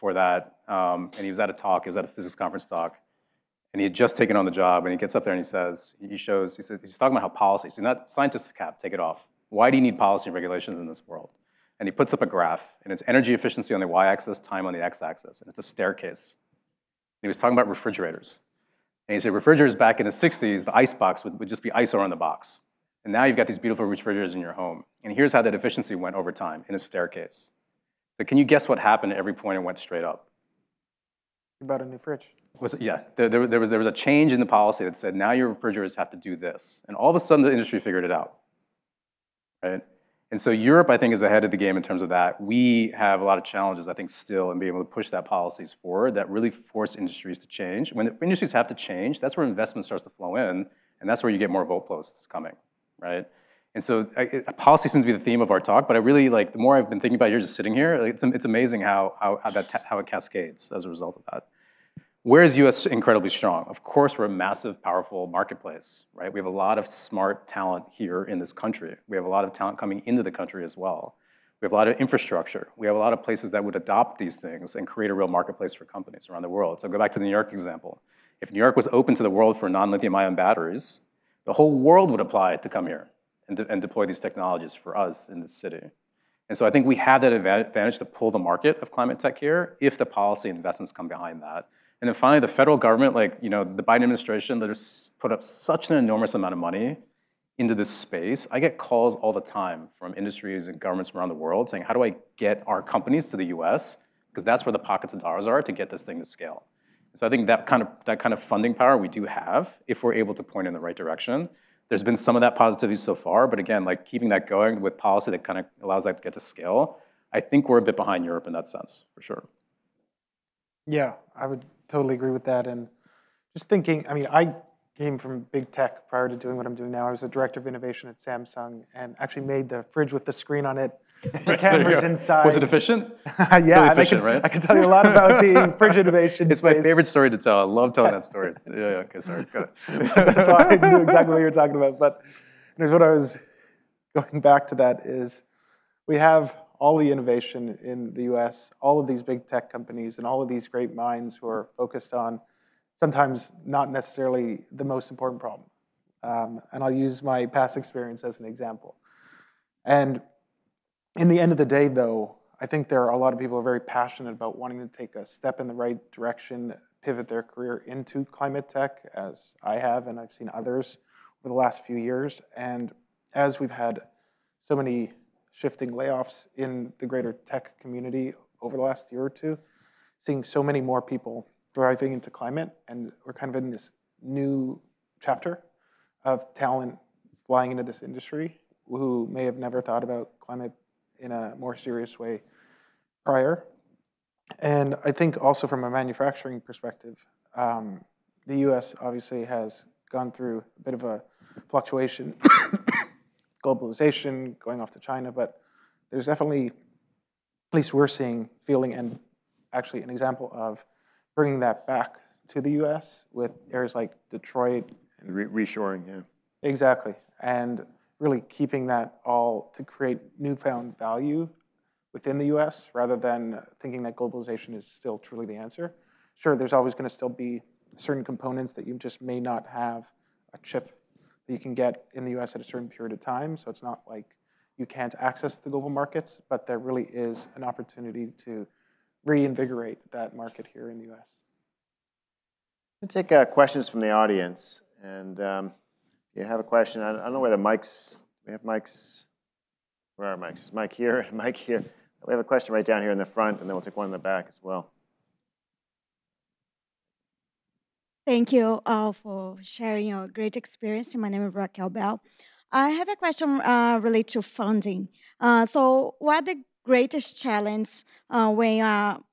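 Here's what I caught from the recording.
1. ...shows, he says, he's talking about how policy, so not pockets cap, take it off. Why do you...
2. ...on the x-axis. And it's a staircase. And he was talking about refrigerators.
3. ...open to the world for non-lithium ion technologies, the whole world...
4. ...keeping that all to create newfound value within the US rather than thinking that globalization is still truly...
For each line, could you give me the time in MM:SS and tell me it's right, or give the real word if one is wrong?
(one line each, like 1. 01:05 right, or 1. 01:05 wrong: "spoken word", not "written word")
1. 00:06 wrong: "scientists", not "pockets"
2. 00:14 right
3. 01:18 wrong: "batteries", not "technologies"
4. 03:38 right.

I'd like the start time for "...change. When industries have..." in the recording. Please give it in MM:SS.
00:47.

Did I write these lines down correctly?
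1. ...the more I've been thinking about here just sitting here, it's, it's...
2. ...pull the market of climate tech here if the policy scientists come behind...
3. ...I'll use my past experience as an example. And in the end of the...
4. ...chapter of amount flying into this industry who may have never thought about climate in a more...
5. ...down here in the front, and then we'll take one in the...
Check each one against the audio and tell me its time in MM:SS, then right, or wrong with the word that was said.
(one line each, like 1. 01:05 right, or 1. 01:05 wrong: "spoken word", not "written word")
1. 00:56 right
2. 01:28 wrong: "investments", not "scientists"
3. 02:36 right
4. 03:05 wrong: "talent", not "amount"
5. 04:12 right.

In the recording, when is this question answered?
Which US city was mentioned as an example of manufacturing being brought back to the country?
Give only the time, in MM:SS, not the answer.
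03:34.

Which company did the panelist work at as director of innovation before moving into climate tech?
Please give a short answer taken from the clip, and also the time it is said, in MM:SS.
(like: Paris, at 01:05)
Samsung, at 02:08.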